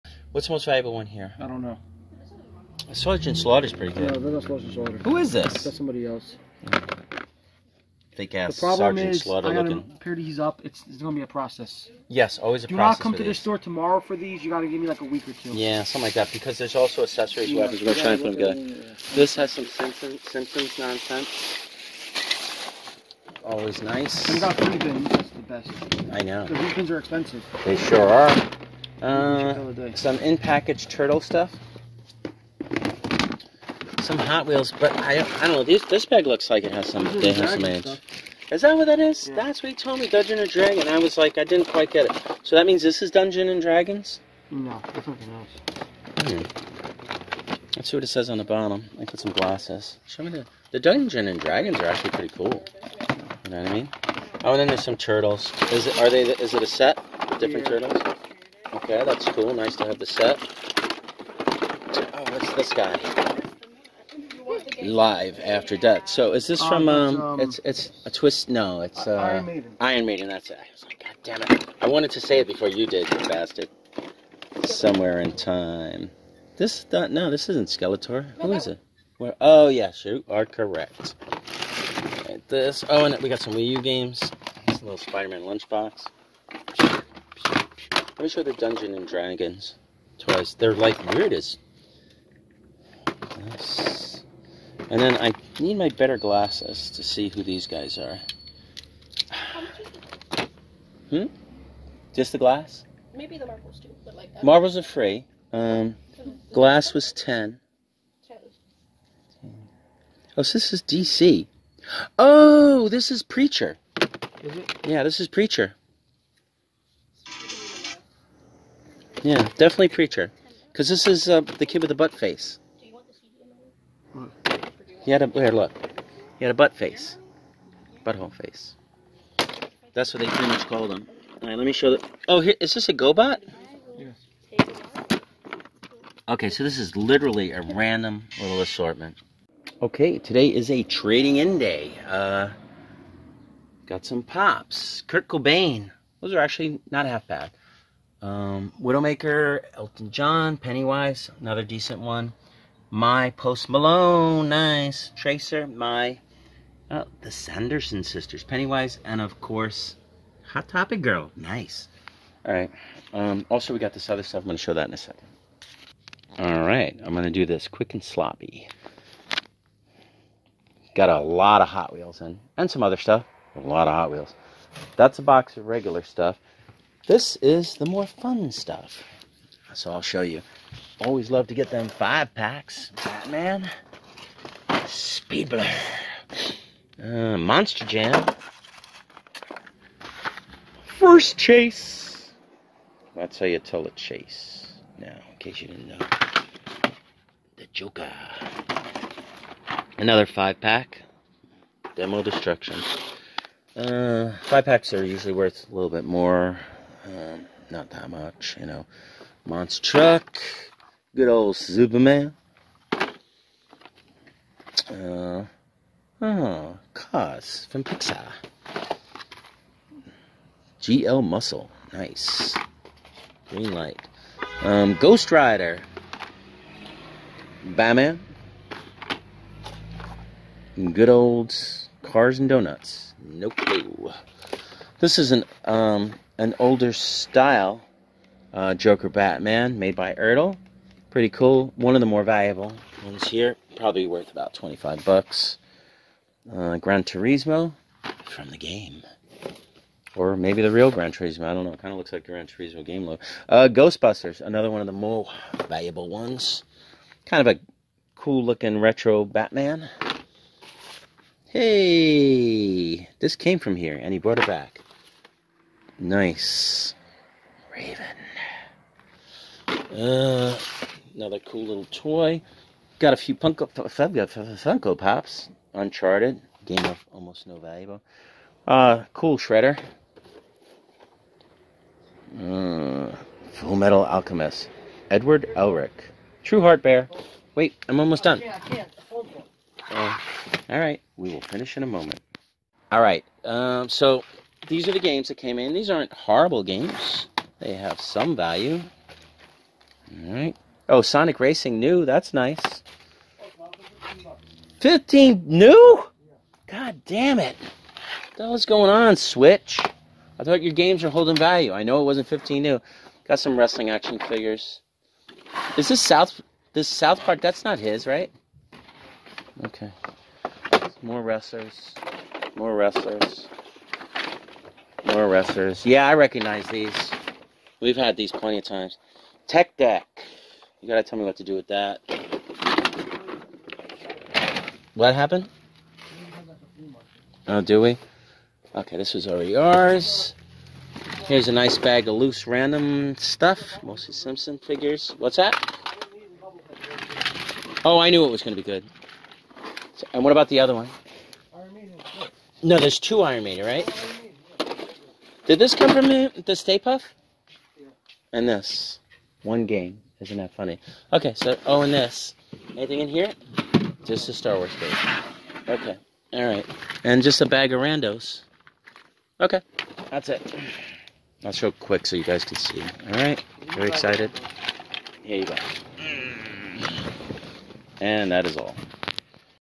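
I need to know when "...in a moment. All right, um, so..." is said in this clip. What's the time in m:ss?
4:51.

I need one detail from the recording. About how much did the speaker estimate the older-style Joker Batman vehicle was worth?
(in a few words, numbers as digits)
$25.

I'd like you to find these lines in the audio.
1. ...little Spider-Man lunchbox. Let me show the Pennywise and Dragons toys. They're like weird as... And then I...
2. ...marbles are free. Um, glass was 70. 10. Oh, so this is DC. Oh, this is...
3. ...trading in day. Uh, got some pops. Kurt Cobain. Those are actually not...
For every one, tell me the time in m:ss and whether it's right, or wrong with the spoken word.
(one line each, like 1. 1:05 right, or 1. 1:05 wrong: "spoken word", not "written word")
1. 1:24 wrong: "Dungeon", not "Pennywise"
2. 1:44 wrong: "10", not "70"
3. 2:20 right.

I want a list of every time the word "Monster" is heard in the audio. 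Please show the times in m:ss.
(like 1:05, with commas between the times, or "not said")
3:07, 3:29.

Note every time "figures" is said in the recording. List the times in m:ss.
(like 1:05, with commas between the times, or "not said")
5:14, 5:44.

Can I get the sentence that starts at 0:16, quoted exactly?
Because there's also accessories, yeah, weapons.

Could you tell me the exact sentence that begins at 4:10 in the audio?
Or maybe the real Gran Turismo.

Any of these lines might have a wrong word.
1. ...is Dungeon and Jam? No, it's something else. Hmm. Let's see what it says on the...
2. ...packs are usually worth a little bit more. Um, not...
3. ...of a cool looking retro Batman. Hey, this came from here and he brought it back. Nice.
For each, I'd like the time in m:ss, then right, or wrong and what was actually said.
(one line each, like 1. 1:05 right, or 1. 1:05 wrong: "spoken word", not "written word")
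1. 0:43 wrong: "Dragons", not "Jam"
2. 3:24 right
3. 4:17 right.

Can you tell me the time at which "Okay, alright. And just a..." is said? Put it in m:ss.
6:05.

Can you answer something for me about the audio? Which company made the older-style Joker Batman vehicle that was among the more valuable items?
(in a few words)
Ertl.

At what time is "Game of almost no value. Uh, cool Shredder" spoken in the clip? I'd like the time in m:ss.
4:36.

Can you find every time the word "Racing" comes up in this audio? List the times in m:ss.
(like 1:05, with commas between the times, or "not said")
5:01.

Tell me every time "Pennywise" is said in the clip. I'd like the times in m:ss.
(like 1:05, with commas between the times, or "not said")
2:30, 2:38.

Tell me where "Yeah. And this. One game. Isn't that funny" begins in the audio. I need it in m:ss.
5:57.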